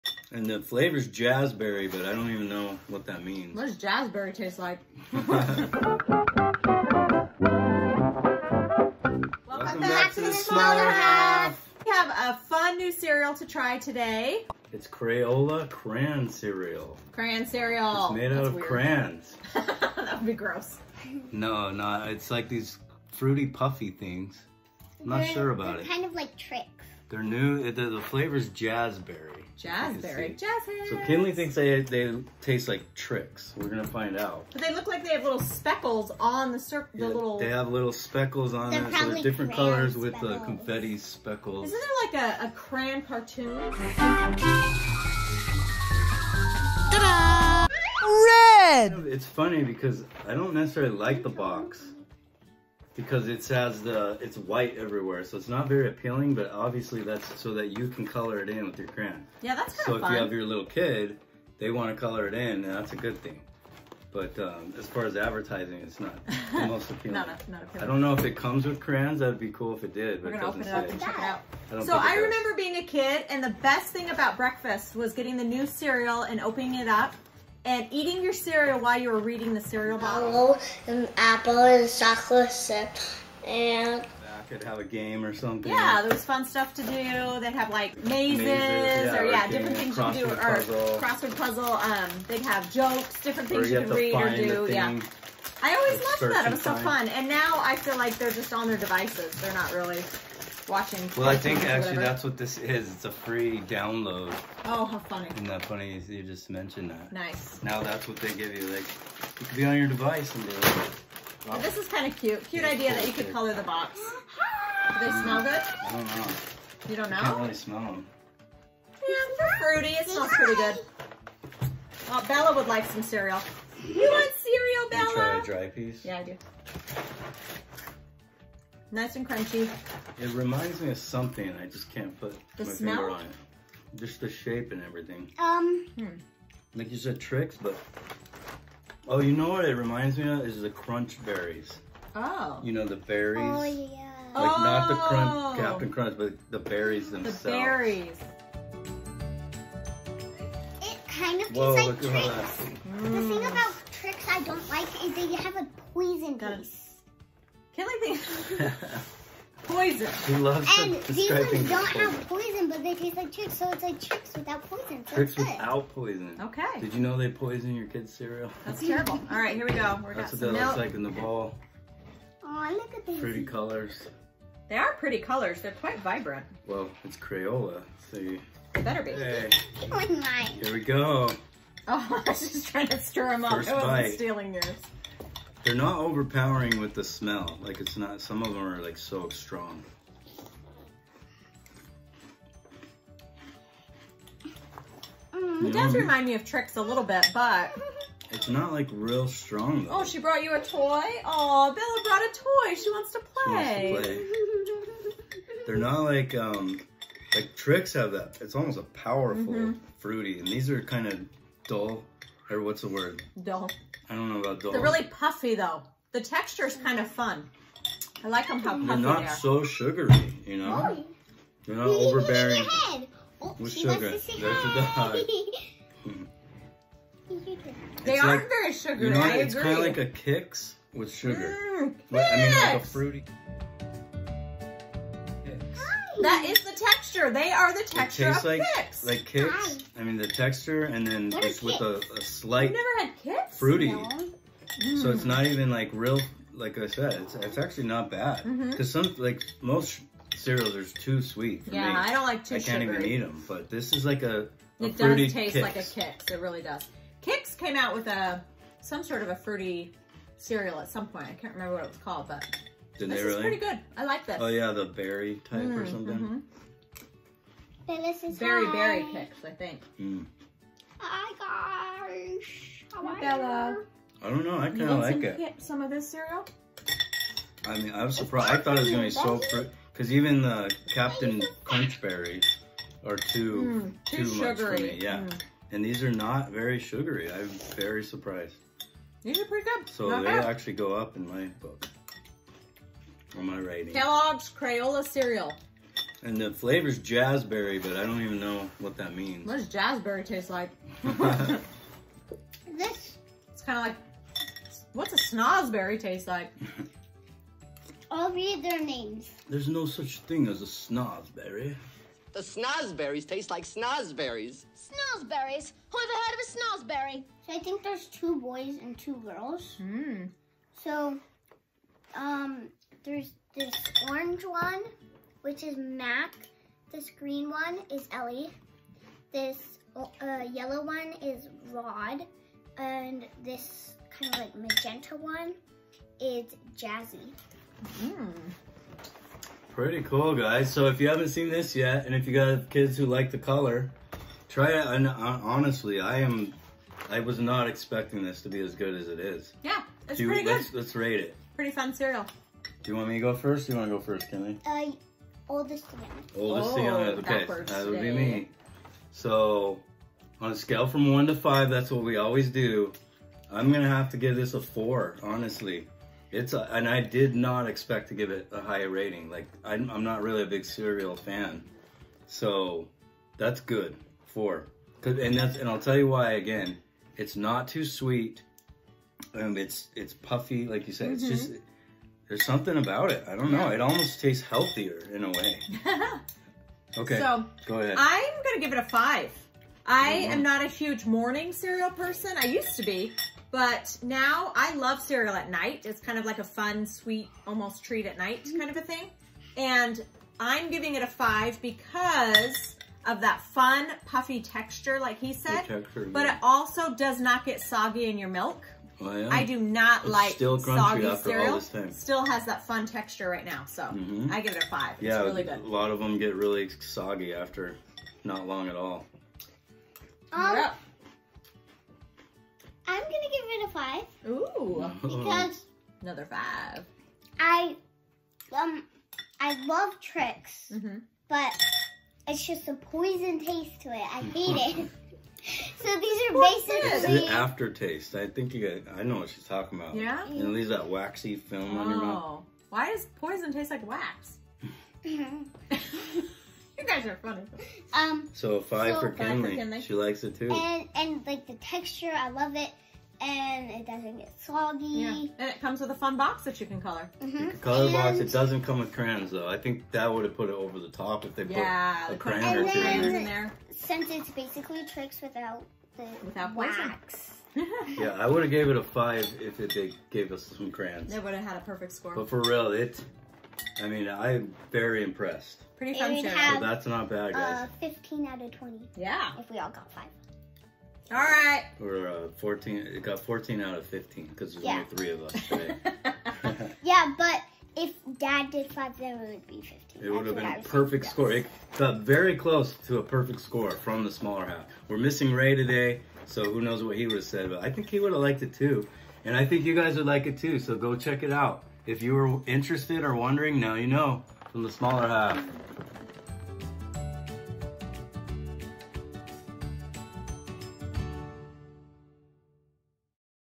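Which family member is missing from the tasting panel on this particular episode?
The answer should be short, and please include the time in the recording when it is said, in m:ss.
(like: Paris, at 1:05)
Ray, at 8:14.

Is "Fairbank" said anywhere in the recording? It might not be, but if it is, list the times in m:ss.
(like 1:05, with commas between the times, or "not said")
not said.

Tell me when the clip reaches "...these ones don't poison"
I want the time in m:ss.
2:41.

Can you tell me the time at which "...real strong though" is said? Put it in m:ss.
3:18.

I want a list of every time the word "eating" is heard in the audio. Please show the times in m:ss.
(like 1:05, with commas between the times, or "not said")
1:17.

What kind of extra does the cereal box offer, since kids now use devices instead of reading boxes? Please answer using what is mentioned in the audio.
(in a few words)
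A free download.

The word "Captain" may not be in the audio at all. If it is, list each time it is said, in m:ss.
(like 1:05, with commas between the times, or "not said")
2:25, 4:40.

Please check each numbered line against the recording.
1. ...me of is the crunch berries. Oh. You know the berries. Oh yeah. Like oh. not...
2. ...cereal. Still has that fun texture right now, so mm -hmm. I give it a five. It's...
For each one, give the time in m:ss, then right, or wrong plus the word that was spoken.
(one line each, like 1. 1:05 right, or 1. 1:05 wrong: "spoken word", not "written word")
1. 2:20 right
2. 6:51 right.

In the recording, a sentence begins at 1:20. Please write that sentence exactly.
and apple and chocolate chip and I could have a game or something.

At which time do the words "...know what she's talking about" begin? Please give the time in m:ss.
7:19.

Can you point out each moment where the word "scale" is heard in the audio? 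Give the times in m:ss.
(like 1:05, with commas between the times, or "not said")
6:00.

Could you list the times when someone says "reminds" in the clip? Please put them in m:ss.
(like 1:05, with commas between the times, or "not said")
2:10, 2:19, 3:15.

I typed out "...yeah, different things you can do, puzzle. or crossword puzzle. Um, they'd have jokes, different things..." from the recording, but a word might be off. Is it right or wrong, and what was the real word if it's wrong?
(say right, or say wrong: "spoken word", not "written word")
right.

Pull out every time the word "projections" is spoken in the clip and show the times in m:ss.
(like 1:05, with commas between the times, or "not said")
not said.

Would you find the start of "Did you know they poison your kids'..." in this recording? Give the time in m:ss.
2:46.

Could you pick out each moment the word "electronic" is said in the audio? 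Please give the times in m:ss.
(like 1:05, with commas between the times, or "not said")
not said.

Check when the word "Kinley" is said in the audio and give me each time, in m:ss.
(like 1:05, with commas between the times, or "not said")
0:31, 7:29.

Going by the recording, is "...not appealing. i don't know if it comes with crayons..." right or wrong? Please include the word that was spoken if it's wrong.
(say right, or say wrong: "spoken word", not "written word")
right.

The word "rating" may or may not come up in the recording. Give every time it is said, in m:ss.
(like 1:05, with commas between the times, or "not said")
4:53, 6:08.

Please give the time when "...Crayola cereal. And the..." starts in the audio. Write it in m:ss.
4:54.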